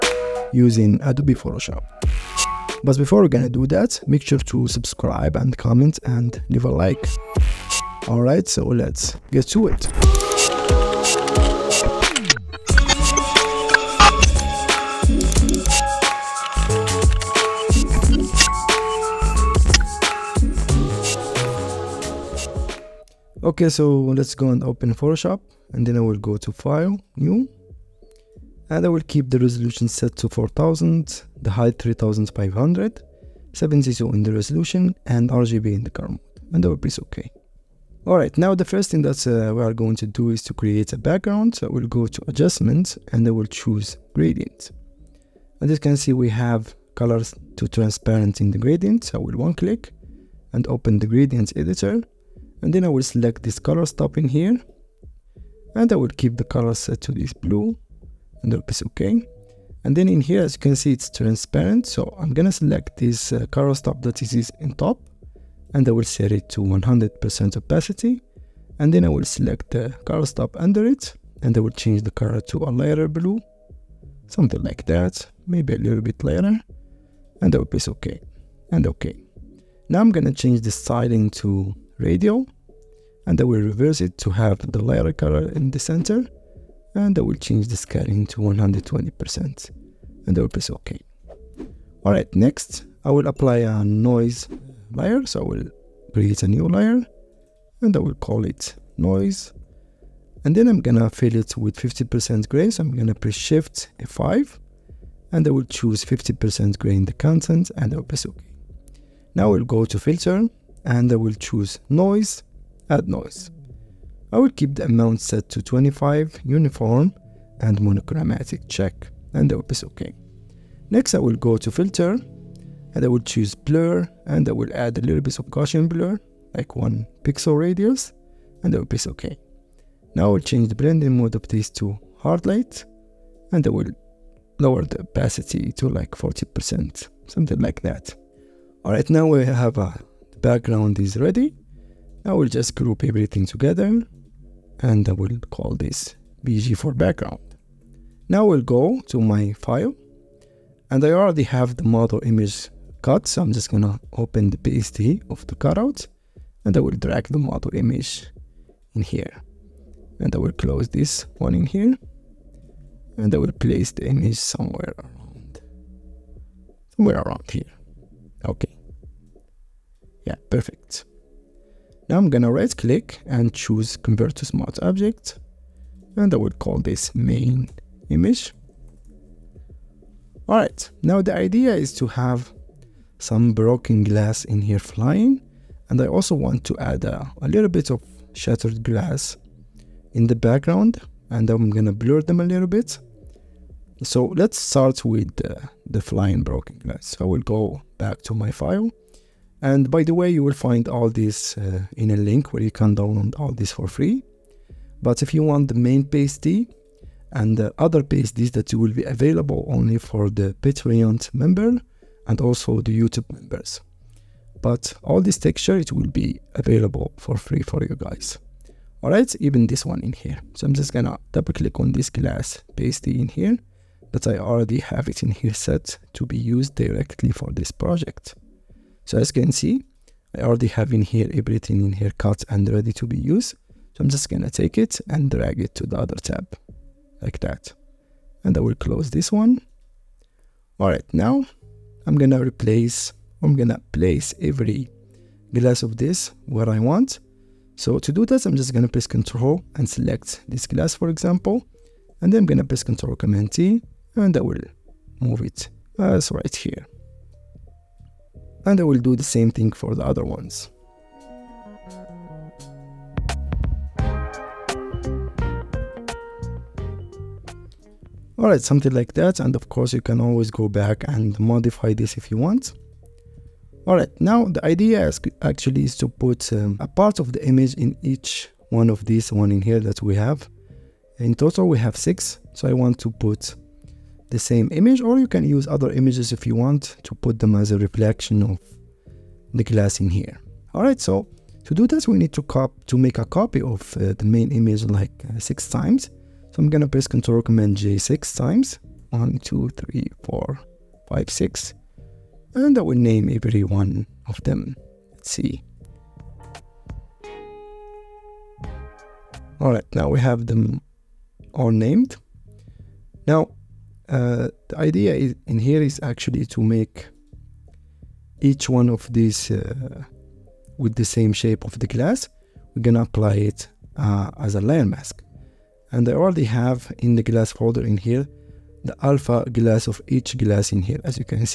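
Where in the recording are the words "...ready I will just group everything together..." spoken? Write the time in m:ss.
2:21.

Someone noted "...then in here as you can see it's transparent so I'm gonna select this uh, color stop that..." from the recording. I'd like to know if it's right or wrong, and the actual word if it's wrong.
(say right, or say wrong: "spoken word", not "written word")
right.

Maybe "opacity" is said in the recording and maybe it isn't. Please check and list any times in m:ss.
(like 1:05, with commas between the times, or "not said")
1:07, 2:15.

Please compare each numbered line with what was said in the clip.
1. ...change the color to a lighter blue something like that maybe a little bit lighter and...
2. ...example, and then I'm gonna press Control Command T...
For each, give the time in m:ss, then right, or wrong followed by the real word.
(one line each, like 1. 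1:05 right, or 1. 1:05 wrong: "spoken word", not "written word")
1. 1:11 right
2. 4:11 right.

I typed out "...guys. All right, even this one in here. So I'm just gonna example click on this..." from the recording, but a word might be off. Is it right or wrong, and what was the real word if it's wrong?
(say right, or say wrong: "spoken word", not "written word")
wrong: "double", not "example".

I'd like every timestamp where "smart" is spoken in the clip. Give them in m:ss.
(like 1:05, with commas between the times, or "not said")
2:54.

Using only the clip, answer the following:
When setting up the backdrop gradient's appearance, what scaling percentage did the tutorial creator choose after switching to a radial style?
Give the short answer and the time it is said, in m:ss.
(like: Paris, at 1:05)
120%, at 1:28.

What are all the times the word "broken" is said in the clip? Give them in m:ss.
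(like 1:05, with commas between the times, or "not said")
3:03, 3:16.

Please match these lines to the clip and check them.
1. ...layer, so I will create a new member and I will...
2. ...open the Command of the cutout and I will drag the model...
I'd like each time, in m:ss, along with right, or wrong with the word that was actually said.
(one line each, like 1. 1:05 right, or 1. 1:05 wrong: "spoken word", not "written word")
1. 1:34 wrong: "layer", not "member"
2. 2:34 wrong: "PSD", not "Command".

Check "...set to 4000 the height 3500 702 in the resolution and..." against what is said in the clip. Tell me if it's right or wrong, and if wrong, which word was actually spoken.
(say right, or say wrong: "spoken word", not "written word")
right.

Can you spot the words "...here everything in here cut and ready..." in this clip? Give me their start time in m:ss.
3:51.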